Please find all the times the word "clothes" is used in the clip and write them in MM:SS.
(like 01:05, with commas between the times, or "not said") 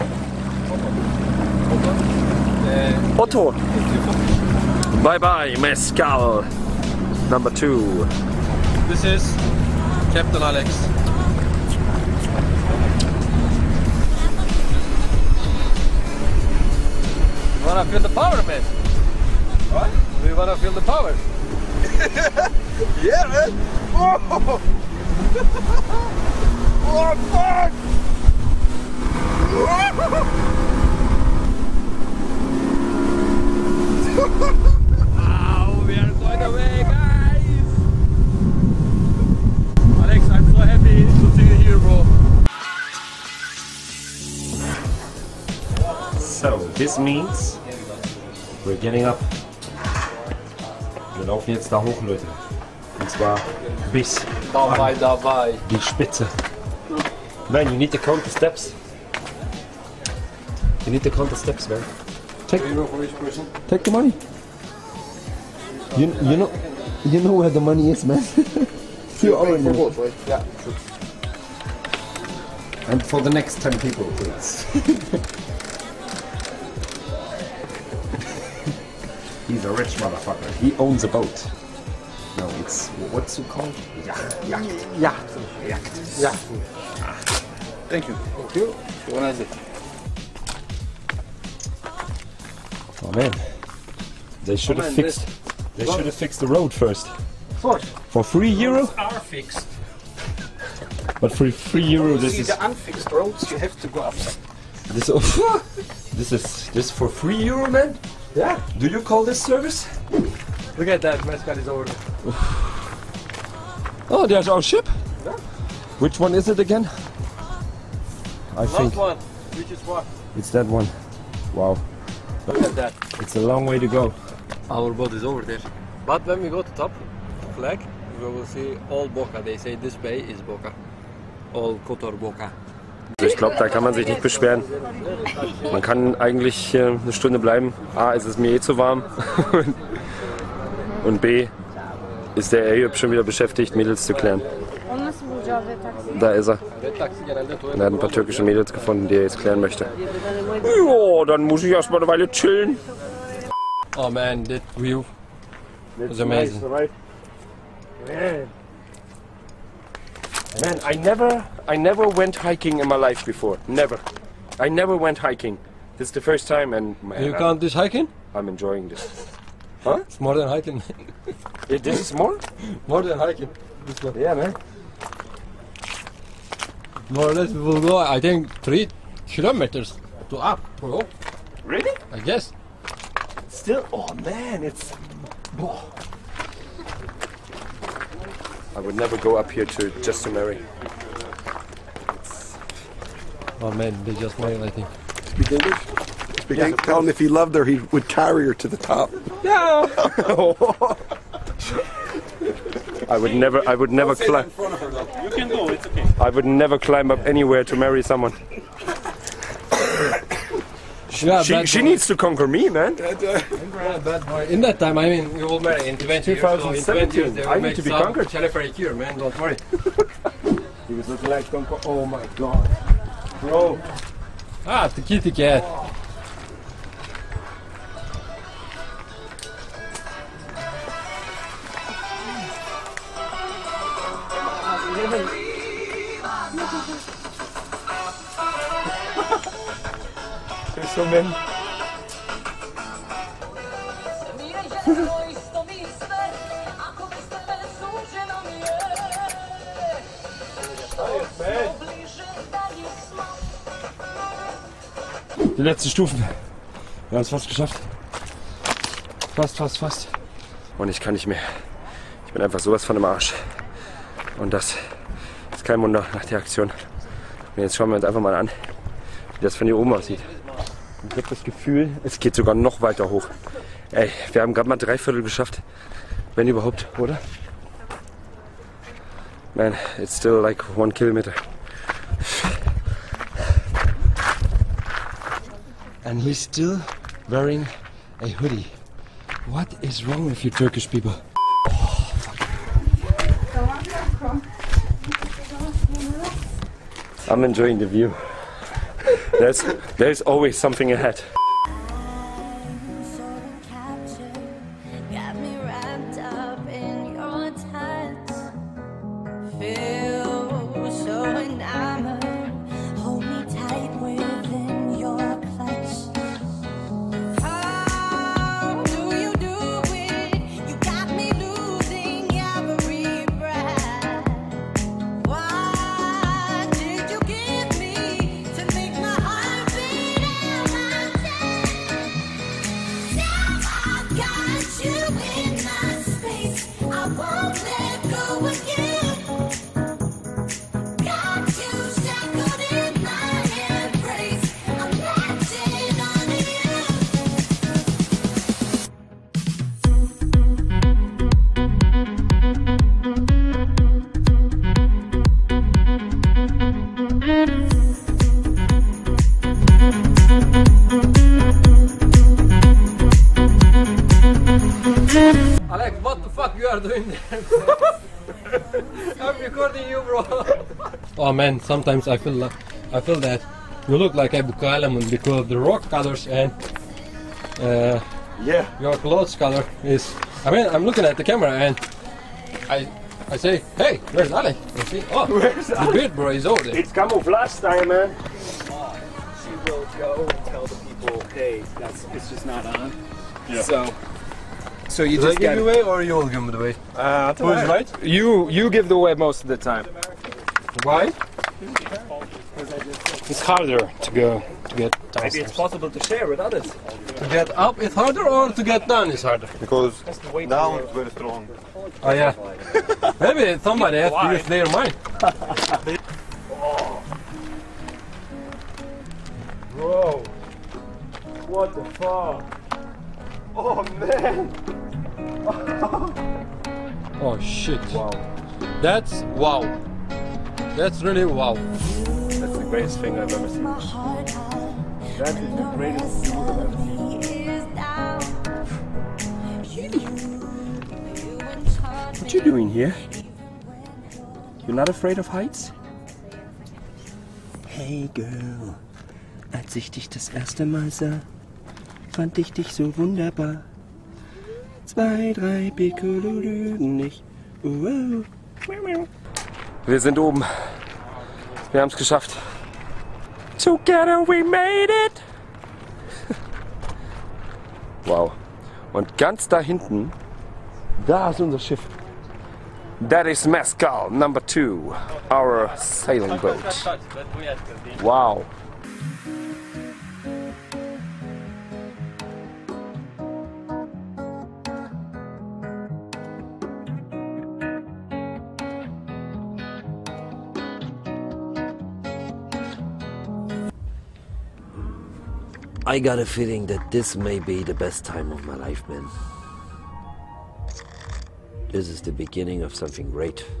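06:18.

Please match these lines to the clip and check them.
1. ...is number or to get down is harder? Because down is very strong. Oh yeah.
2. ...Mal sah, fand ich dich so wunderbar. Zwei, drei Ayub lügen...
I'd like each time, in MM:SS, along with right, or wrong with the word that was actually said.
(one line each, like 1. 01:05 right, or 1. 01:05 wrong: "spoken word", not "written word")
1. 06:47 wrong: "harder", not "number"
2. 07:30 wrong: "Piccolo", not "Ayub".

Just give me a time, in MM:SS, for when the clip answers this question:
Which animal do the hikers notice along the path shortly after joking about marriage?
03:45.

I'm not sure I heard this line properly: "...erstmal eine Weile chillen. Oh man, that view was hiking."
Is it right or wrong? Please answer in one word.
wrong.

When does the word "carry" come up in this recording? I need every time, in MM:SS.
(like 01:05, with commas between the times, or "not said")
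03:18.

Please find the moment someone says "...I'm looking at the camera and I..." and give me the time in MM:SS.
06:20.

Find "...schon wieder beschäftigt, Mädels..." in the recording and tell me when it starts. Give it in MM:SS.
02:22.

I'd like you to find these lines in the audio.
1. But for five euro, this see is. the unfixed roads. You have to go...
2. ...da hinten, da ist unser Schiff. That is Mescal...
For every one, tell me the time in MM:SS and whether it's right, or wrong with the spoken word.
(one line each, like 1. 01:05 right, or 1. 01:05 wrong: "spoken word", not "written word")
1. 01:41 wrong: "three", not "five"
2. 07:49 right.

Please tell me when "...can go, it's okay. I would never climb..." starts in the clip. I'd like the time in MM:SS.
03:25.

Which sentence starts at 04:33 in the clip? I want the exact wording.
Ey, wir haben gerade mal drei Viertel geschafft.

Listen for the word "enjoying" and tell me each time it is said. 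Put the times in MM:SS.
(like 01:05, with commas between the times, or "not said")
02:48, 04:57.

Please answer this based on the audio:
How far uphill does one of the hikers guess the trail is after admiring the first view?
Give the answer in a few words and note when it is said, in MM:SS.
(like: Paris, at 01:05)
3 kilometers, at 02:58.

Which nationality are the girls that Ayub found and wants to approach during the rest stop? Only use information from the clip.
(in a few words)
Turkish.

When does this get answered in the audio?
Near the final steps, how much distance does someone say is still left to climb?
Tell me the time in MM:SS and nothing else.
04:40.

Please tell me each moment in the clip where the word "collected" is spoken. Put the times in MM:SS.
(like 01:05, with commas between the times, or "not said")
not said.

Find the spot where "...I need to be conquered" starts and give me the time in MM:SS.
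03:37.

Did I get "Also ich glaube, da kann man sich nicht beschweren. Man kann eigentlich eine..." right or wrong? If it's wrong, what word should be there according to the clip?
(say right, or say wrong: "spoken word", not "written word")
right.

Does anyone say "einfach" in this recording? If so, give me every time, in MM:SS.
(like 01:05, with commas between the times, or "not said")
04:22, 04:28.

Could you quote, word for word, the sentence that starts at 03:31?
she, she needs to conquer me, man.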